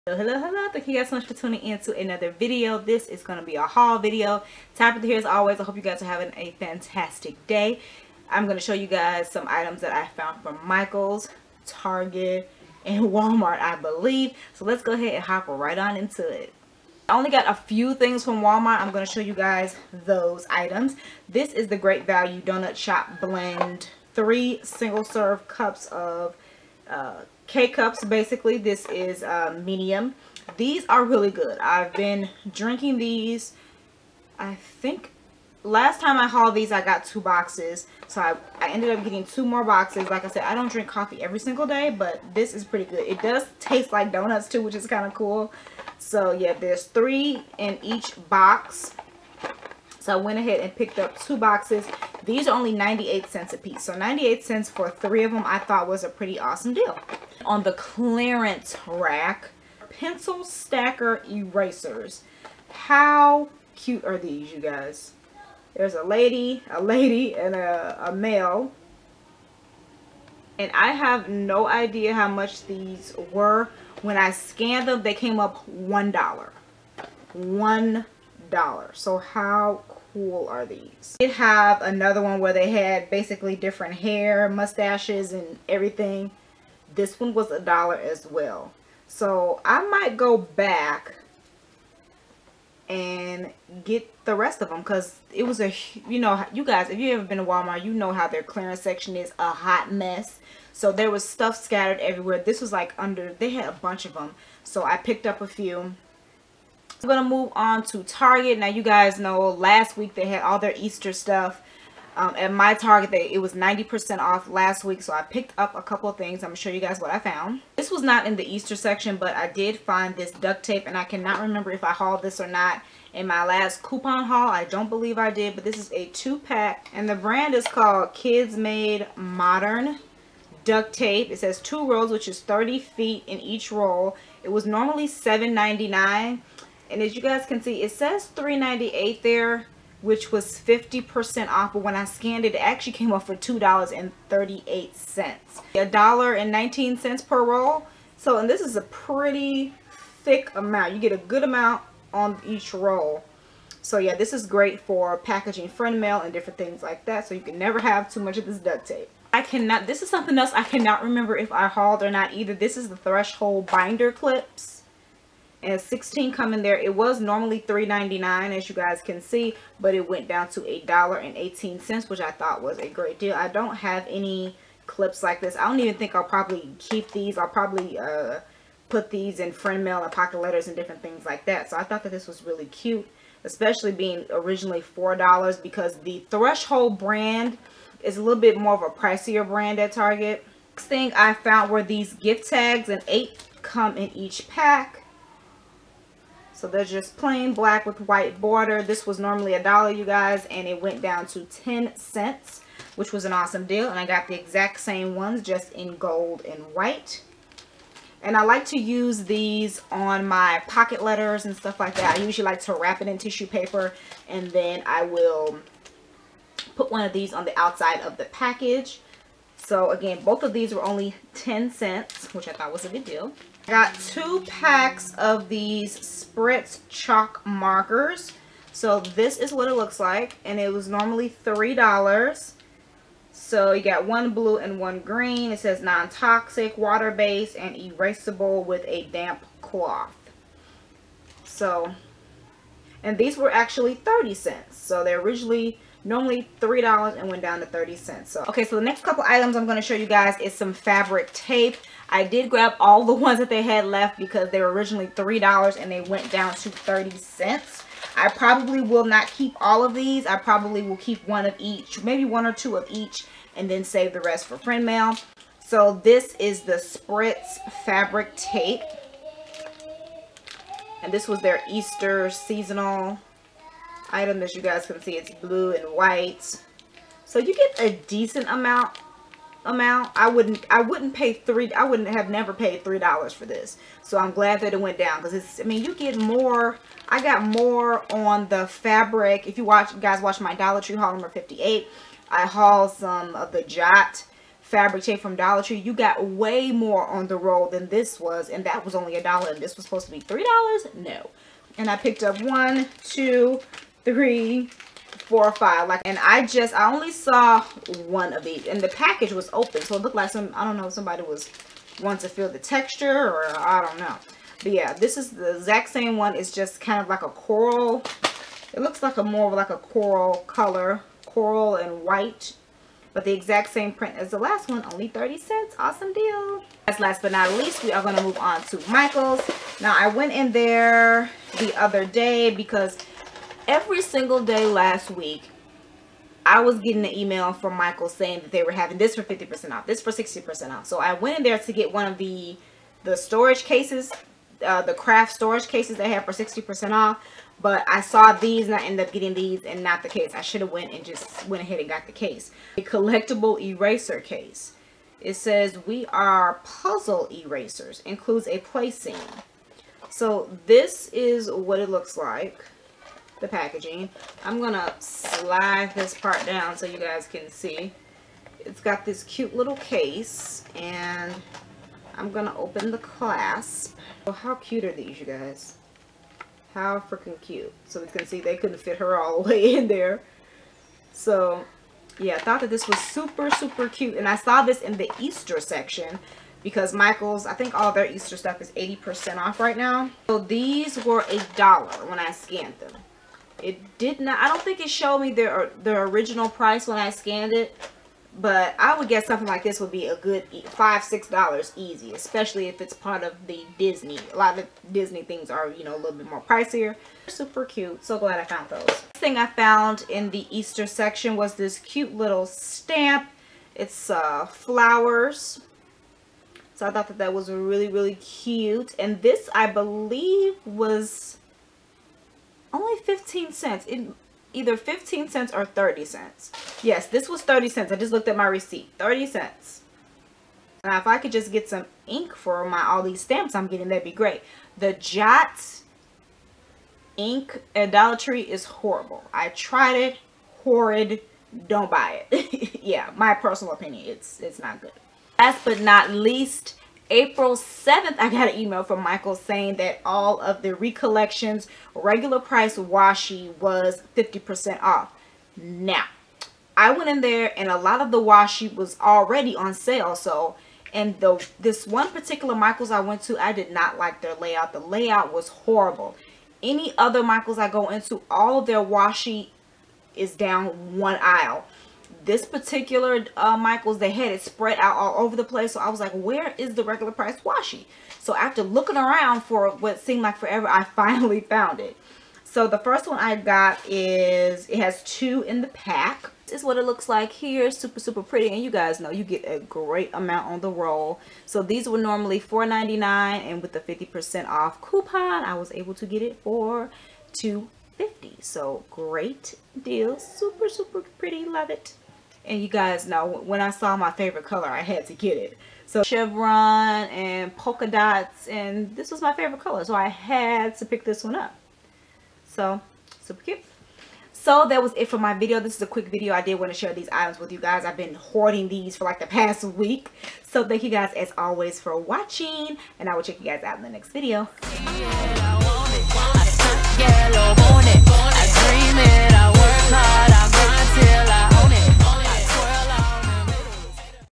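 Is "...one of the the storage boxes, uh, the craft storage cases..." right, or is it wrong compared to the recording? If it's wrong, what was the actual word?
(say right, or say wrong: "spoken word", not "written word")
wrong: "cases", not "boxes".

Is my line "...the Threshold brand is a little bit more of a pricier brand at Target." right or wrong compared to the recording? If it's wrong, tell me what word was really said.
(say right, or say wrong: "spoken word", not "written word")
right.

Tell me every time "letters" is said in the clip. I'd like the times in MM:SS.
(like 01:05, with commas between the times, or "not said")
03:00, 03:31.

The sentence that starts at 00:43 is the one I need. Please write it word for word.
It does taste like donuts too, which is kind of cool.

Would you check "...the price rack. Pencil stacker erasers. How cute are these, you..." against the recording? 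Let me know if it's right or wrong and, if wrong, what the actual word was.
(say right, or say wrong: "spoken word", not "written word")
wrong: "clearance", not "price".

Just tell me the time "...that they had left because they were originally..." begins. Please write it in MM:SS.
04:13.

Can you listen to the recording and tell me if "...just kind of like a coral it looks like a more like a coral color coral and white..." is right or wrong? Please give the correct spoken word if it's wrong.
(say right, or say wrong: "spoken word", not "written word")
right.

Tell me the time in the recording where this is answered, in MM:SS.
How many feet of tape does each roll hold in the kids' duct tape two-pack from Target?
02:12.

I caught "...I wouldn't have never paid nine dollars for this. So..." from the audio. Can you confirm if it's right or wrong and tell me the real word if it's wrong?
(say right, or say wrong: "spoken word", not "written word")
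wrong: "three", not "nine".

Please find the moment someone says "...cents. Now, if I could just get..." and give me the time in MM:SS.
07:09.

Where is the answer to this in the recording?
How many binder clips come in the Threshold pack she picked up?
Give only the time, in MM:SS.
02:45.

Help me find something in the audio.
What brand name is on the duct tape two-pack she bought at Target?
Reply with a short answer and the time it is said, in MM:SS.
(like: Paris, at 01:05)
Kids Made Modern, at 02:08.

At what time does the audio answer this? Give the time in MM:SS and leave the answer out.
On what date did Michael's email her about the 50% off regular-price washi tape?
07:27.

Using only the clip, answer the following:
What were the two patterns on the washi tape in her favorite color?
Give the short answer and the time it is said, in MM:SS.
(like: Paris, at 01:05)
chevron and polka dots, at 08:26.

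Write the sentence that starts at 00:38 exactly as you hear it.
So I, I ended up getting two more boxes.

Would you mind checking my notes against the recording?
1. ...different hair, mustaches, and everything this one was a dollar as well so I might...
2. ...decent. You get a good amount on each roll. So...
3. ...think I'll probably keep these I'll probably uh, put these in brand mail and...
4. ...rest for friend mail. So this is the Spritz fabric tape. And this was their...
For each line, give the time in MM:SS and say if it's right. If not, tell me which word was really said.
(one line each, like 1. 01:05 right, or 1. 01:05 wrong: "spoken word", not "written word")
1. 01:23 right
2. 02:30 wrong: "amount", not "decent"
3. 02:55 wrong: "friend", not "brand"
4. 04:24 right.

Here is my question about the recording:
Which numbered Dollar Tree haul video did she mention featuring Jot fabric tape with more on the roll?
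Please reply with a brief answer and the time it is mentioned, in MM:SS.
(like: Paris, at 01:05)
58, at 04:51.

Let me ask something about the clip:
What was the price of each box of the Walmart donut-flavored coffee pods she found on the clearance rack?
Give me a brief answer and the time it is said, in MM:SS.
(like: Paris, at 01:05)
98 cents, at 00:52.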